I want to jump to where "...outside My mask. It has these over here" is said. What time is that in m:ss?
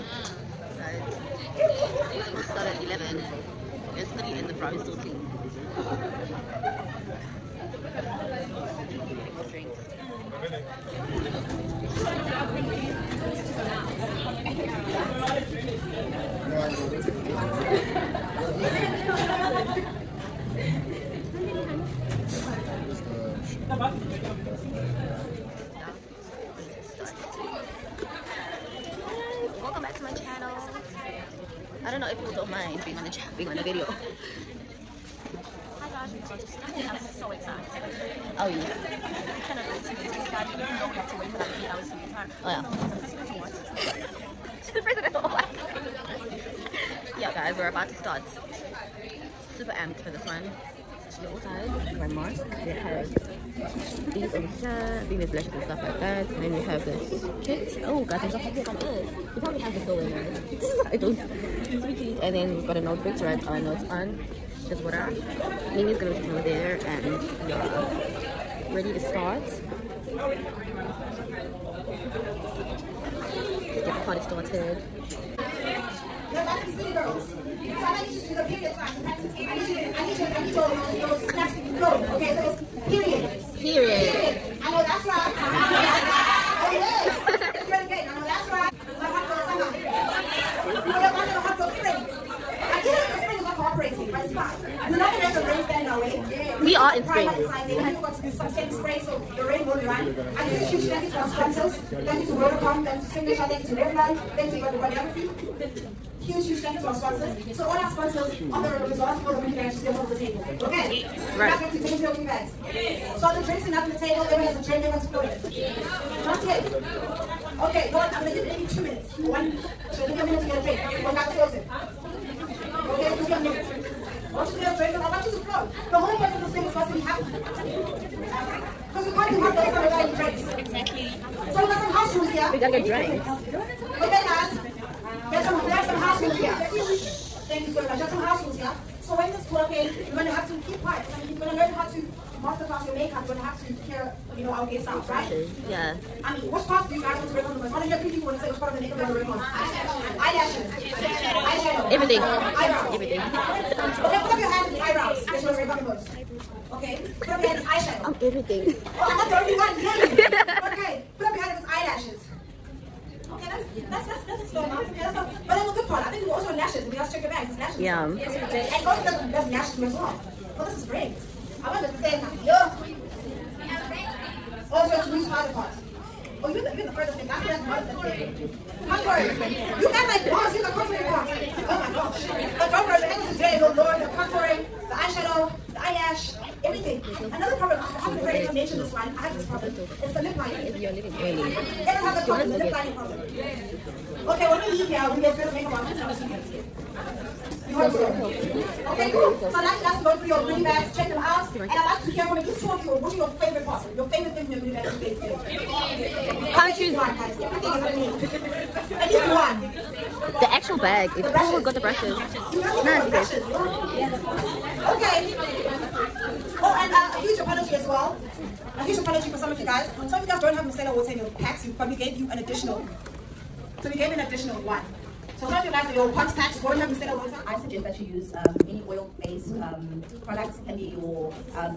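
0:51.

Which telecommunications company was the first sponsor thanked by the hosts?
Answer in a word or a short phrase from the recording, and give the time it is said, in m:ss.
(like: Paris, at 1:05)
Vodacom, at 1:42.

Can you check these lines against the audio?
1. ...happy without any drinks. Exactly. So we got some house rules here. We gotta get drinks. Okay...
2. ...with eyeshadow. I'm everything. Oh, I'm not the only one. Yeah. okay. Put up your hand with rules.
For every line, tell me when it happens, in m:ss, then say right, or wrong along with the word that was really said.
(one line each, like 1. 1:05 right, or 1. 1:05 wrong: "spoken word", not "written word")
1. 2:09 right
2. 2:37 wrong: "eyelashes", not "rules".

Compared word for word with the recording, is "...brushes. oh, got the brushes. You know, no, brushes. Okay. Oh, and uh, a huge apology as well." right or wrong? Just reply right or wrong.
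right.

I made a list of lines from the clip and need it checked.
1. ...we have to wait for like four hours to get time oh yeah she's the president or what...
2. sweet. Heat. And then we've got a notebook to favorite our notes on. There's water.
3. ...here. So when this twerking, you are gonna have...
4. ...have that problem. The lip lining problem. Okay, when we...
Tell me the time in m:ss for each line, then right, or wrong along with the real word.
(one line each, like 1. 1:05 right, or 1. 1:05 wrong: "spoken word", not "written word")
1. 0:40 wrong: "three", not "four"
2. 1:01 wrong: "write", not "favorite"
3. 2:18 right
4. 3:12 right.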